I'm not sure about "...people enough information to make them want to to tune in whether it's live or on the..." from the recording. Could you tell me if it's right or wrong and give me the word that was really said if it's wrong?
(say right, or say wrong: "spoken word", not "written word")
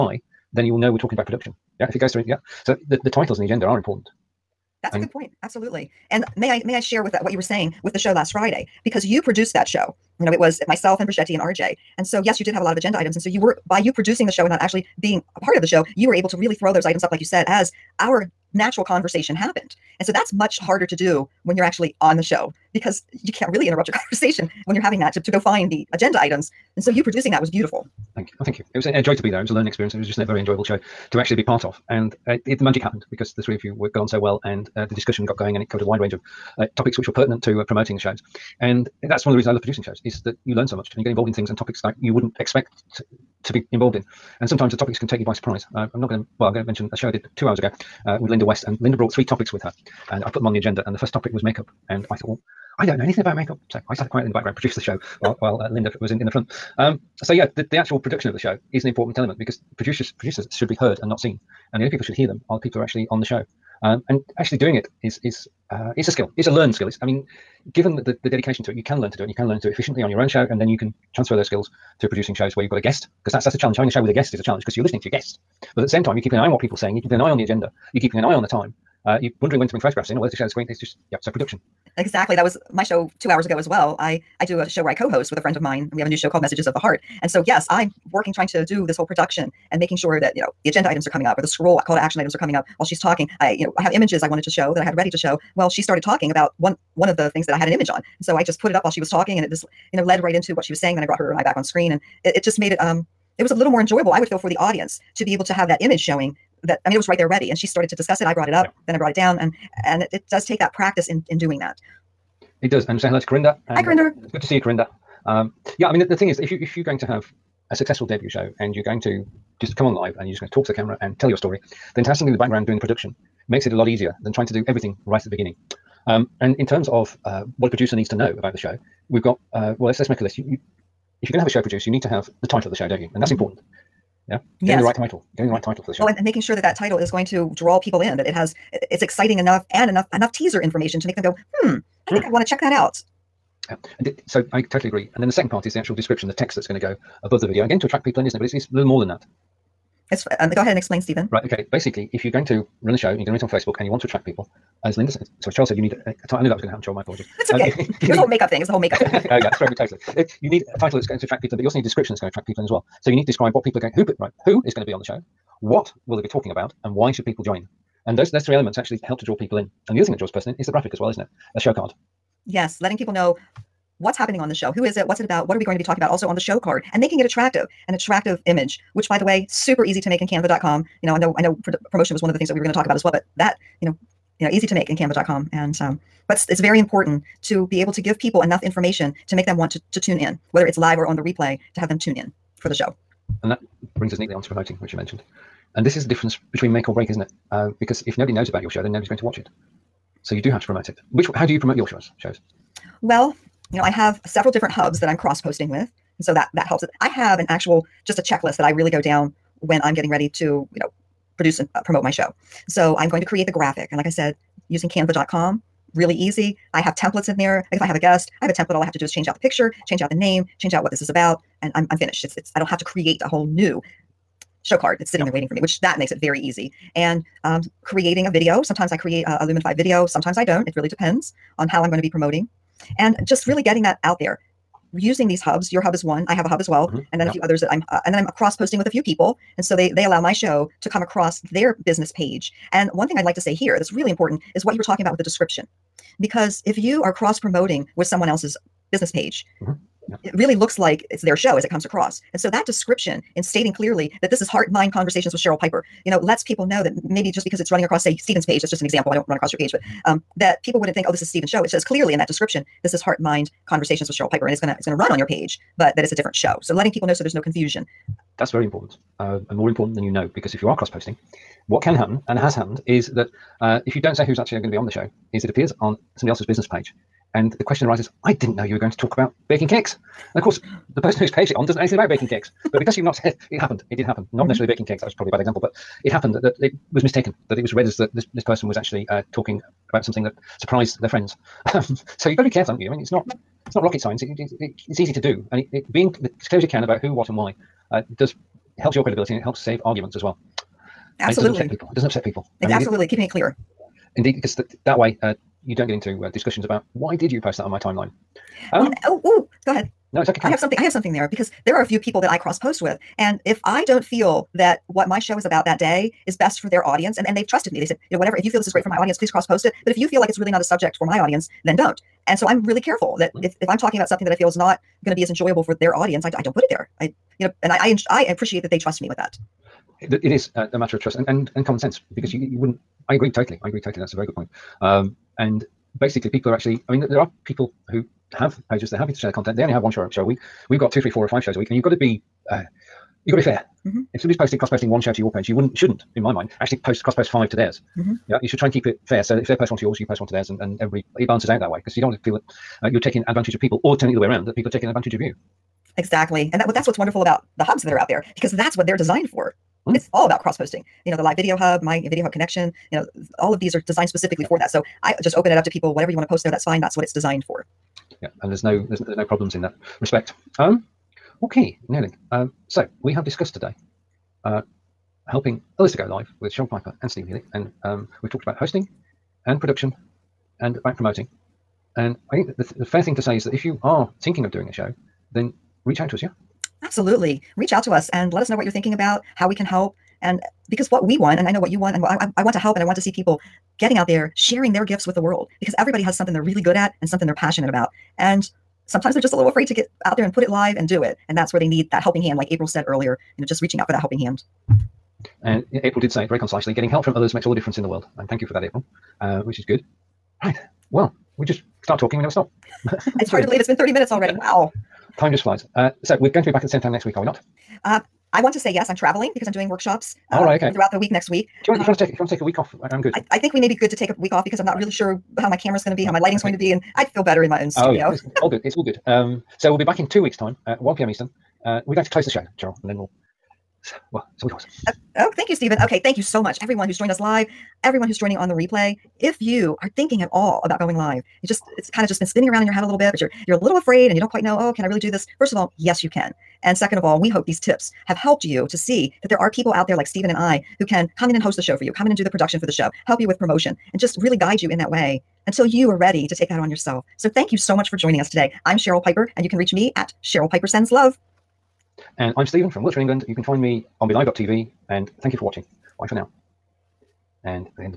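right.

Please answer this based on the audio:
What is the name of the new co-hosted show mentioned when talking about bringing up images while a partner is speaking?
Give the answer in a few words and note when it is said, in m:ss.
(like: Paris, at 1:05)
Messages of the Heart, at 1:26.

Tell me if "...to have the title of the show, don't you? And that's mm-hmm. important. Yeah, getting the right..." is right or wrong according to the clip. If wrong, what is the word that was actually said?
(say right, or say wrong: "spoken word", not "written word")
right.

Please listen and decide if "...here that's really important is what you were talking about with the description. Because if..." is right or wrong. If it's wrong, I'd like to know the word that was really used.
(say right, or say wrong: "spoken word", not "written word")
right.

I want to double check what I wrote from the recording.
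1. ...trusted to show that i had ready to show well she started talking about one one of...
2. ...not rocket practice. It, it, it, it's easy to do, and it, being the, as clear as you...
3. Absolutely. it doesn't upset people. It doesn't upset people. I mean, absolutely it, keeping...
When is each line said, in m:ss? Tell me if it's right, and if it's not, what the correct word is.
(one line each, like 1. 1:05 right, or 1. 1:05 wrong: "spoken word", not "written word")
1. 1:34 wrong: "wanted", not "trusted"
2. 4:53 wrong: "science", not "practice"
3. 5:01 right.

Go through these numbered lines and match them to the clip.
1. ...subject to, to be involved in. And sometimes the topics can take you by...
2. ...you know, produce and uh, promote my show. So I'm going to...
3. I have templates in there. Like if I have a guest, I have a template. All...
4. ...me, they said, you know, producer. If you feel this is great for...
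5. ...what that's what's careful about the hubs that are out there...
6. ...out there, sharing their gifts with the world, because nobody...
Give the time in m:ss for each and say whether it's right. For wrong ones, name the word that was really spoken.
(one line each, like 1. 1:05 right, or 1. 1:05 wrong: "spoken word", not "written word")
1. 0:42 wrong: "expect", not "subject"
2. 3:30 right
3. 3:36 right
4. 5:17 wrong: "whatever", not "producer"
5. 5:56 wrong: "wonderful", not "careful"
6. 6:33 wrong: "everybody", not "nobody".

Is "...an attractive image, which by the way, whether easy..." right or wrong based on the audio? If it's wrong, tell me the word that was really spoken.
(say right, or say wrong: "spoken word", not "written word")
wrong: "super", not "whether".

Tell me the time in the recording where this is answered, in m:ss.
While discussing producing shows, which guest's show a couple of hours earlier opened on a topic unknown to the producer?
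0:48.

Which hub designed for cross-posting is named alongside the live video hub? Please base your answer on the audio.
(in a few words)
My Video Hub Connection.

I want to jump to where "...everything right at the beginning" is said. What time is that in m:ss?
2:04.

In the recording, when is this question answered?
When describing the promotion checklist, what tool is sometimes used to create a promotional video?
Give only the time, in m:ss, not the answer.
3:49.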